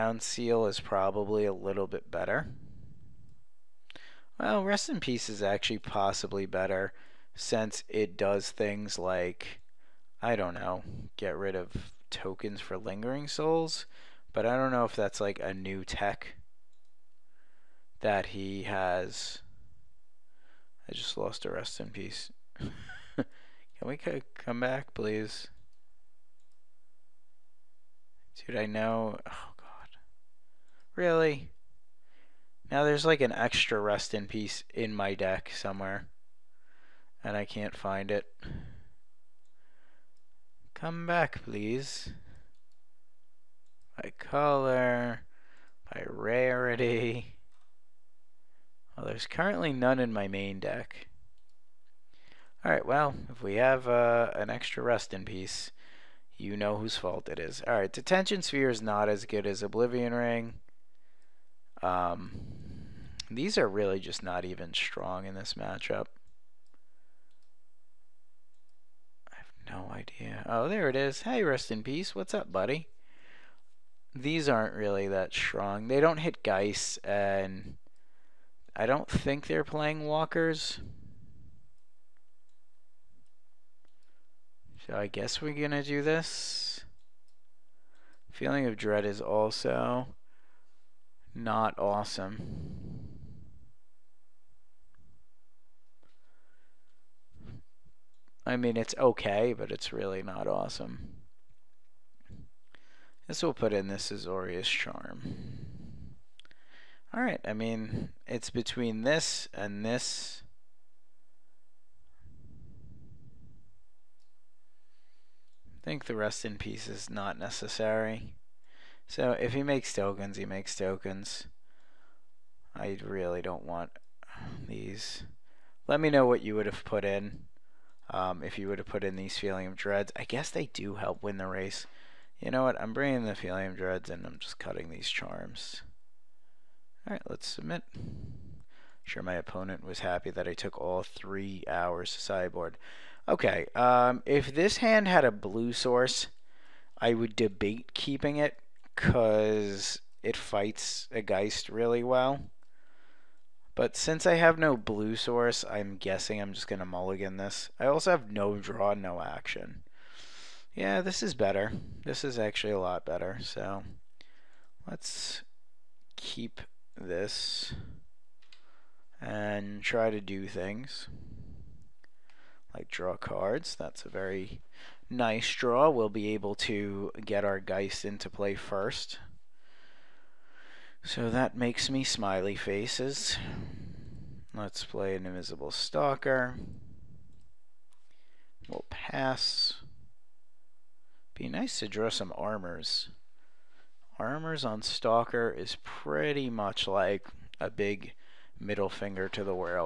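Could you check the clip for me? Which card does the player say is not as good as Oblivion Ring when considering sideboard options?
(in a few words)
Detention Sphere.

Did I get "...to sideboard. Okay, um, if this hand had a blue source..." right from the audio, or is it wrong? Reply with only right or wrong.
right.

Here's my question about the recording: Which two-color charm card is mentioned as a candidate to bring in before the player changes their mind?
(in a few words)
Azorius Charm.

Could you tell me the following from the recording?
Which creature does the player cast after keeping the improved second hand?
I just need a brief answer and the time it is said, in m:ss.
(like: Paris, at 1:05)
Invisible Stalker, at 3:05.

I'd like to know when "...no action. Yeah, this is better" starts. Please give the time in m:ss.
2:38.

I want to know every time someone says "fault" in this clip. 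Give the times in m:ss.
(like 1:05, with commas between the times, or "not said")
0:56.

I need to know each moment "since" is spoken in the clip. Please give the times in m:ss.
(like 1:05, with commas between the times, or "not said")
0:07, 2:33.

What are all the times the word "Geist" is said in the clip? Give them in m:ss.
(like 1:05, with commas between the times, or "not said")
1:16, 2:31, 2:57.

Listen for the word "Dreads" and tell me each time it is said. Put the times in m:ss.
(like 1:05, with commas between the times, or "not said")
1:28, 2:09, 2:13.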